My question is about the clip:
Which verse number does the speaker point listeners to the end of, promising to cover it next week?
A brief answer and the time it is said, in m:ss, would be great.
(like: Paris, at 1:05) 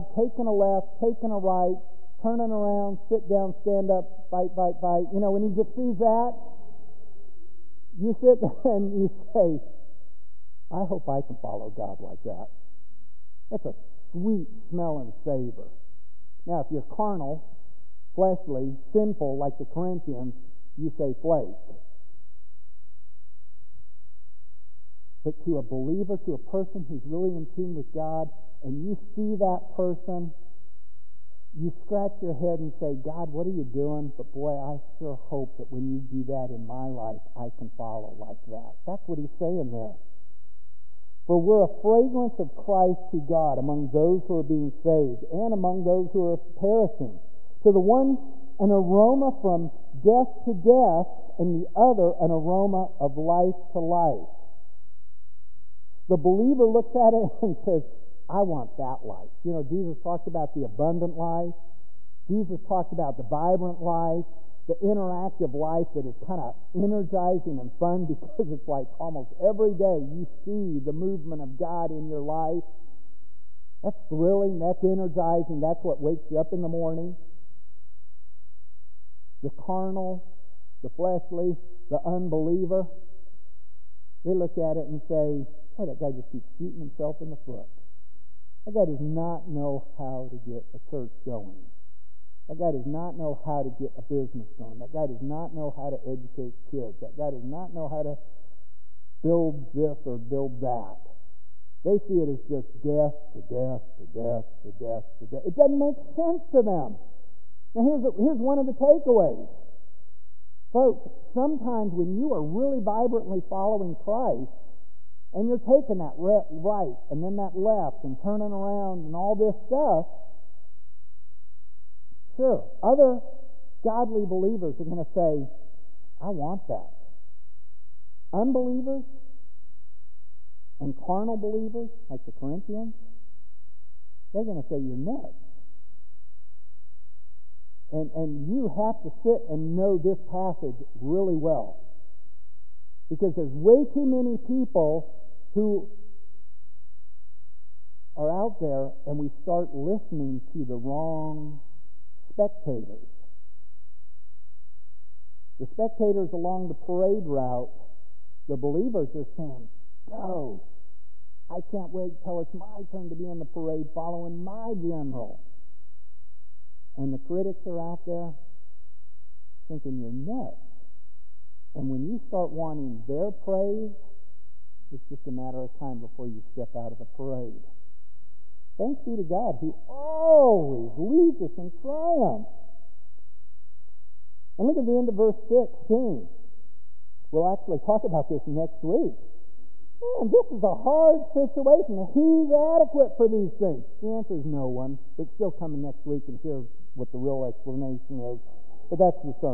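16, at 3:05.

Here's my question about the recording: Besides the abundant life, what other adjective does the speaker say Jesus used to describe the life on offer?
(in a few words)
Vibrant.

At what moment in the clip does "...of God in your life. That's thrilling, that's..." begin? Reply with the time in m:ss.
1:11.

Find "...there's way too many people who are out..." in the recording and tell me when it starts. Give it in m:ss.
2:23.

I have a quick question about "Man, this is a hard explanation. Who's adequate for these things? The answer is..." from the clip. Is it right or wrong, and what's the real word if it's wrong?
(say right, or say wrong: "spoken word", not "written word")
wrong: "situation", not "explanation".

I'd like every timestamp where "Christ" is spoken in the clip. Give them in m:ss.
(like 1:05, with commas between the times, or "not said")
0:42, 1:53.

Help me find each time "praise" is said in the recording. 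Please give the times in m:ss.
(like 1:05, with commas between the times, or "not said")
2:53.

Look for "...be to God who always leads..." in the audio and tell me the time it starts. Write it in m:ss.
2:59.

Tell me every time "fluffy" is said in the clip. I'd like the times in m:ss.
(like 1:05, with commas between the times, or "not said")
not said.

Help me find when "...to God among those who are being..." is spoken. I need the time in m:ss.
0:43.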